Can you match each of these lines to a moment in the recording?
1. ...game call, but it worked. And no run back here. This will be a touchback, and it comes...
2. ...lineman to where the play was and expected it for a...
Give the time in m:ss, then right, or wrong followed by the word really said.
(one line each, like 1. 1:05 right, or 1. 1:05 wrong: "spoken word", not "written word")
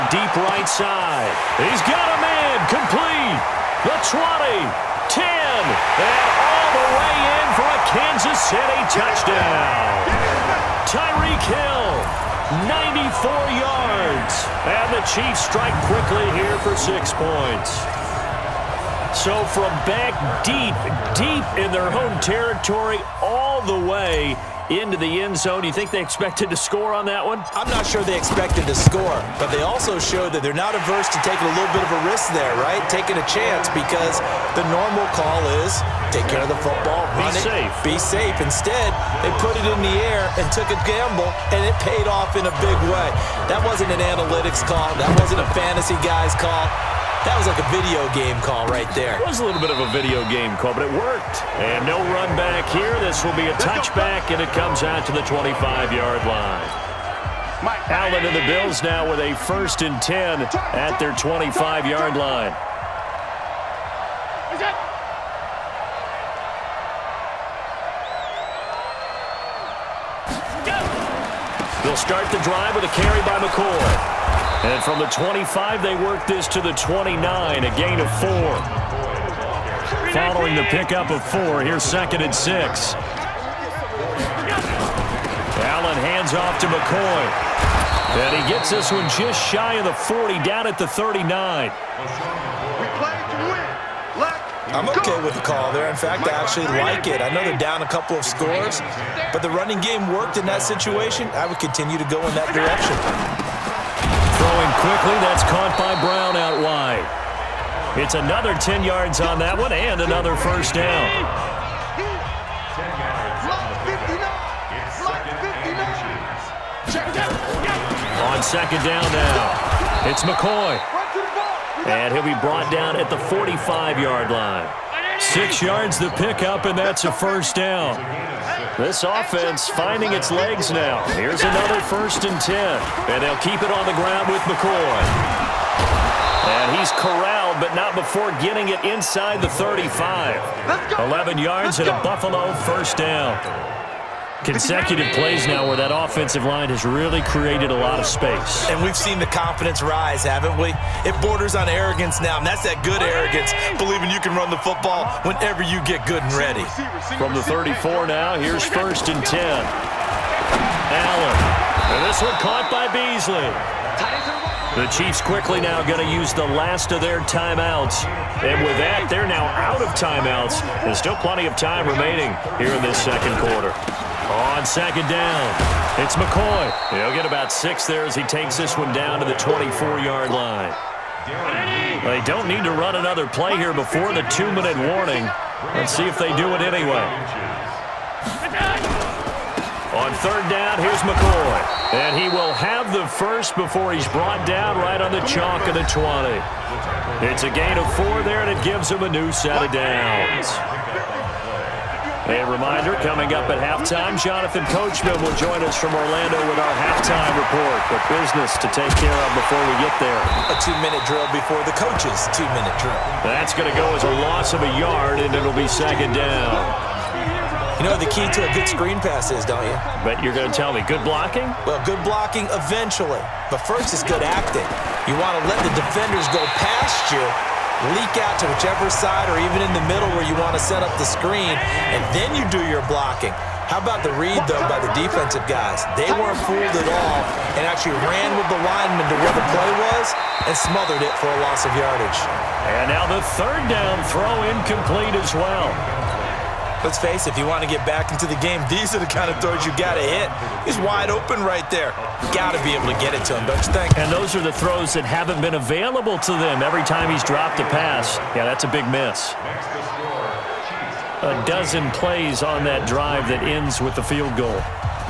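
1. 0:50 right
2. 3:58 wrong: "smothered", not "expected".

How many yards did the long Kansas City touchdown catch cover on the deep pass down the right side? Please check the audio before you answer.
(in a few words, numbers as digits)
94.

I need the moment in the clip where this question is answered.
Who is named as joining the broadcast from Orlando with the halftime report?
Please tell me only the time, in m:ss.
3:24.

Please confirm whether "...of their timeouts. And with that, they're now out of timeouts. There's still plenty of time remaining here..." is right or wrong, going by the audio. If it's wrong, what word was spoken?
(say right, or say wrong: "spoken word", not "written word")
right.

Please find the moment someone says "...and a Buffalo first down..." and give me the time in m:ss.
2:21.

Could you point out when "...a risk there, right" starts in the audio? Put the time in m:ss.
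0:31.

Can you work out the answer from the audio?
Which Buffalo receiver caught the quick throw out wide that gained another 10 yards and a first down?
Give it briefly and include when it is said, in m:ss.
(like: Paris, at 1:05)
Brown, at 1:46.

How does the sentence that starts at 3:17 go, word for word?
It's a gain of four there, and it gives him a new set of downs.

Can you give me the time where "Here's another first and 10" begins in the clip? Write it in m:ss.
2:11.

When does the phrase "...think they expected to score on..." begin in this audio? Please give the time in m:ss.
0:25.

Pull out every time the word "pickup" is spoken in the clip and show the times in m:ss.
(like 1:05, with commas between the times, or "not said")
1:20, 2:06.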